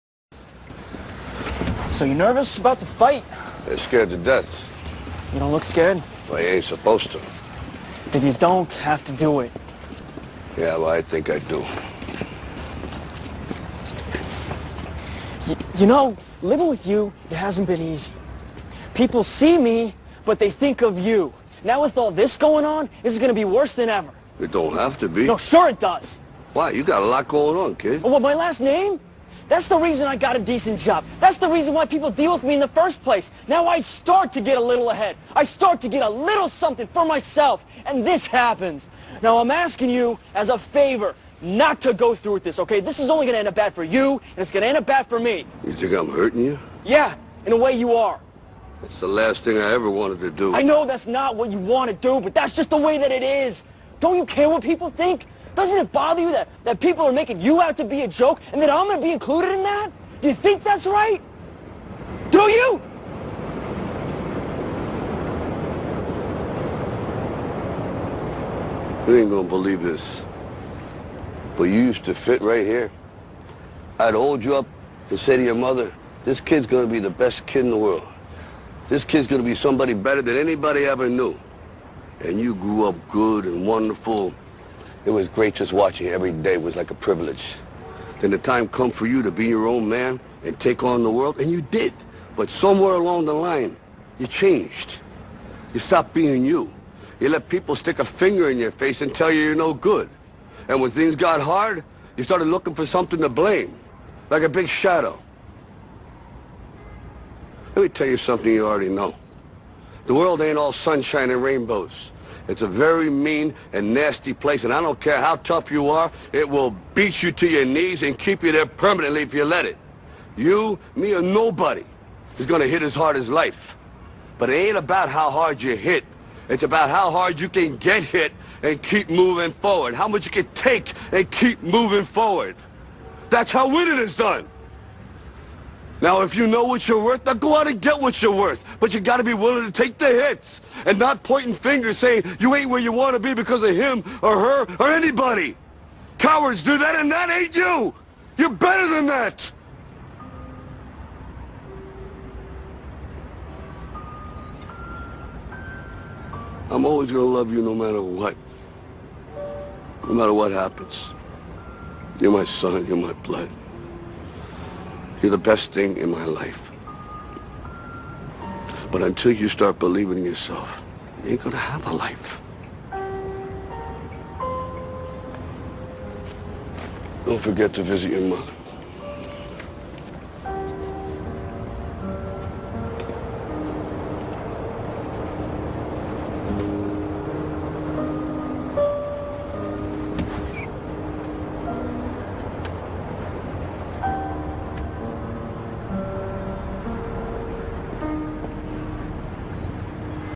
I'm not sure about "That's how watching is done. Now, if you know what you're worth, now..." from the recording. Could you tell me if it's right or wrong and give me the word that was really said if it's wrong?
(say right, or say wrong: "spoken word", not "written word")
wrong: "winning", not "watching".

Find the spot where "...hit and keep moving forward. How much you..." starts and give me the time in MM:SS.
02:08.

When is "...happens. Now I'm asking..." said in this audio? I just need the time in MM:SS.
00:38.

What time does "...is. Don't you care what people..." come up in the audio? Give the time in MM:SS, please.
00:53.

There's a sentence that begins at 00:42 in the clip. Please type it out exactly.
This is only going to end up bad for you, and it's going to end up bad for me.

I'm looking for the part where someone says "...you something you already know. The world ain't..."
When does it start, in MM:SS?
01:48.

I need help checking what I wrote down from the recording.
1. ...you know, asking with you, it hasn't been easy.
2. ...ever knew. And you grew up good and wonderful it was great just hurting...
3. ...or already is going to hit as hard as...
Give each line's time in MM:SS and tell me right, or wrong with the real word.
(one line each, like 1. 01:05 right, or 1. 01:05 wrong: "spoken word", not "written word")
1. 00:15 wrong: "living", not "asking"
2. 01:20 wrong: "watching", not "hurting"
3. 02:01 wrong: "nobody", not "already".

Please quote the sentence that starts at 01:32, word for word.
But somewhere along the line, you changed.